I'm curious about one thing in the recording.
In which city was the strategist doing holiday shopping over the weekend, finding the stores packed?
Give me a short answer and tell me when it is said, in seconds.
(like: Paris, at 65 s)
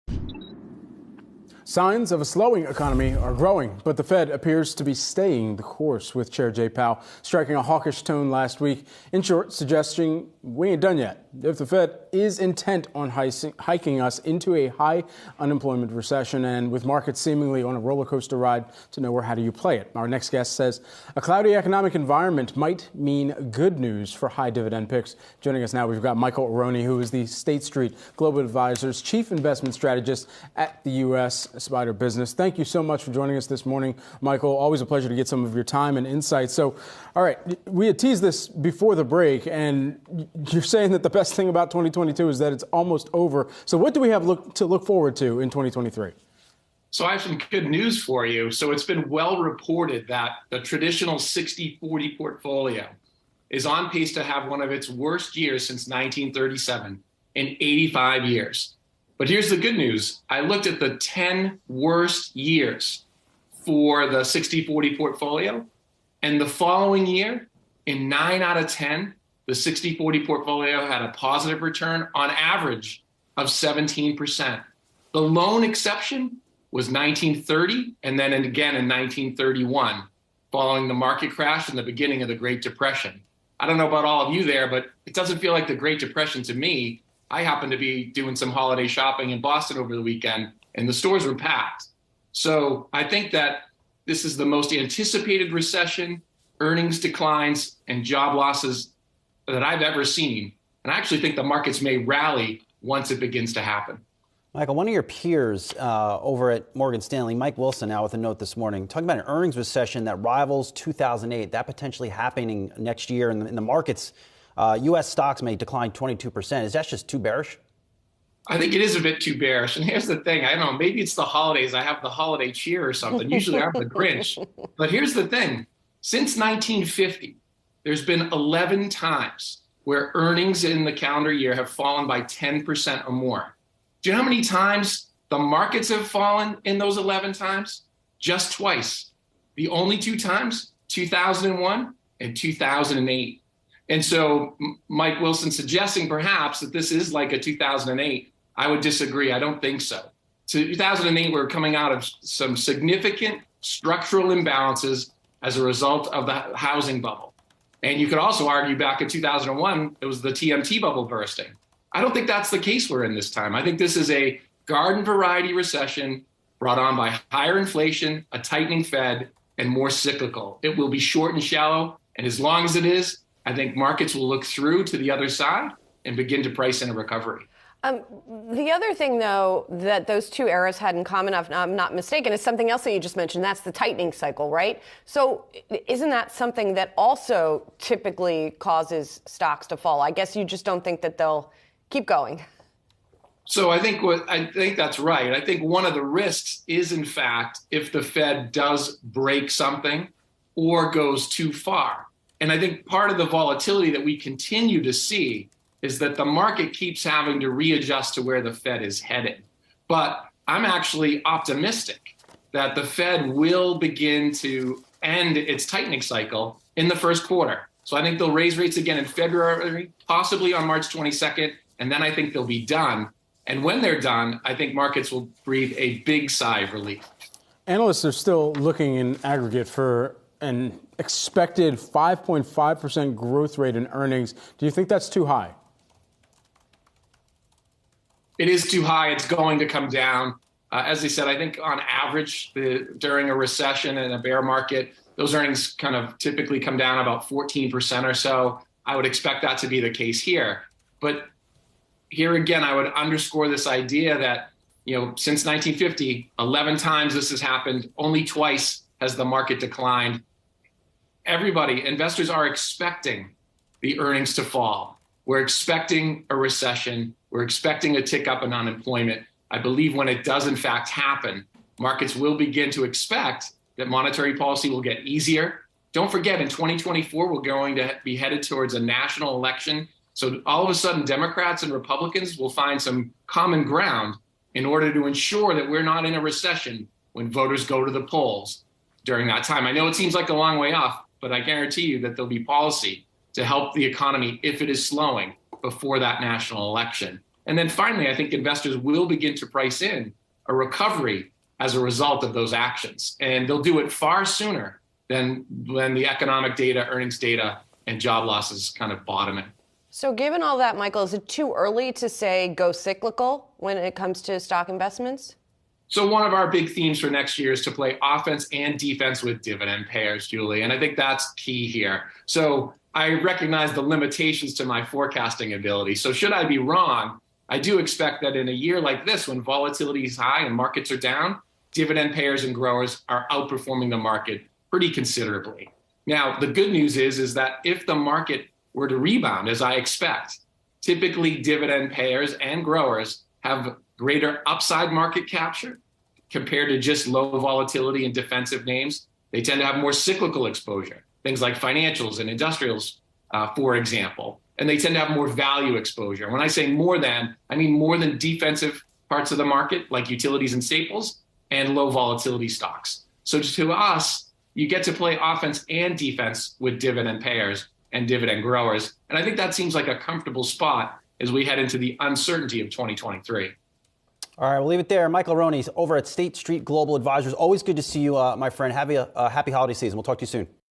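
Boston, at 89 s.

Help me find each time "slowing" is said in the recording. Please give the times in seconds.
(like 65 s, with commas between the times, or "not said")
2 s, 294 s.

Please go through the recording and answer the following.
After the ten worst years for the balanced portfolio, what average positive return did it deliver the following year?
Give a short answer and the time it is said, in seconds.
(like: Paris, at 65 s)
17%, at 73 s.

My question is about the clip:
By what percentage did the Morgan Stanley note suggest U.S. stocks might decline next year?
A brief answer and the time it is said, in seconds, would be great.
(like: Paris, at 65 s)
22%, at 115 s.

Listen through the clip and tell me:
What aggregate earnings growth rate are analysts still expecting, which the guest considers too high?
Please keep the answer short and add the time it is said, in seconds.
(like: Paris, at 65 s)
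5.5%, at 231 s.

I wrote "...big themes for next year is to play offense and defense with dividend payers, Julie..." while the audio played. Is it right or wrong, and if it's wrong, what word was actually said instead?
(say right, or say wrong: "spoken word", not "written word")
right.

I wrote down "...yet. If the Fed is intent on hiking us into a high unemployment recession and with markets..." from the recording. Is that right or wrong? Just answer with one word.
right.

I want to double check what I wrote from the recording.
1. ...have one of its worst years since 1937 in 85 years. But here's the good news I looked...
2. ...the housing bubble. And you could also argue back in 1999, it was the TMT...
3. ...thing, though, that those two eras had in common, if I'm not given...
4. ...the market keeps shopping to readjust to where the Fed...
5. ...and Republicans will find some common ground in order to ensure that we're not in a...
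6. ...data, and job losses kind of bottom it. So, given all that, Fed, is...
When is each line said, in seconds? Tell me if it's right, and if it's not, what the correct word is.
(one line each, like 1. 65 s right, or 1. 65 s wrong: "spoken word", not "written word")
1. 54 s right
2. 156 s wrong: "2001", not "1999"
3. 178 s wrong: "mistaken", not "given"
4. 206 s wrong: "having", not "shopping"
5. 281 s right
6. 307 s wrong: "Michael", not "Fed".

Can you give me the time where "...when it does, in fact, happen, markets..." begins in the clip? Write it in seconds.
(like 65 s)
269 s.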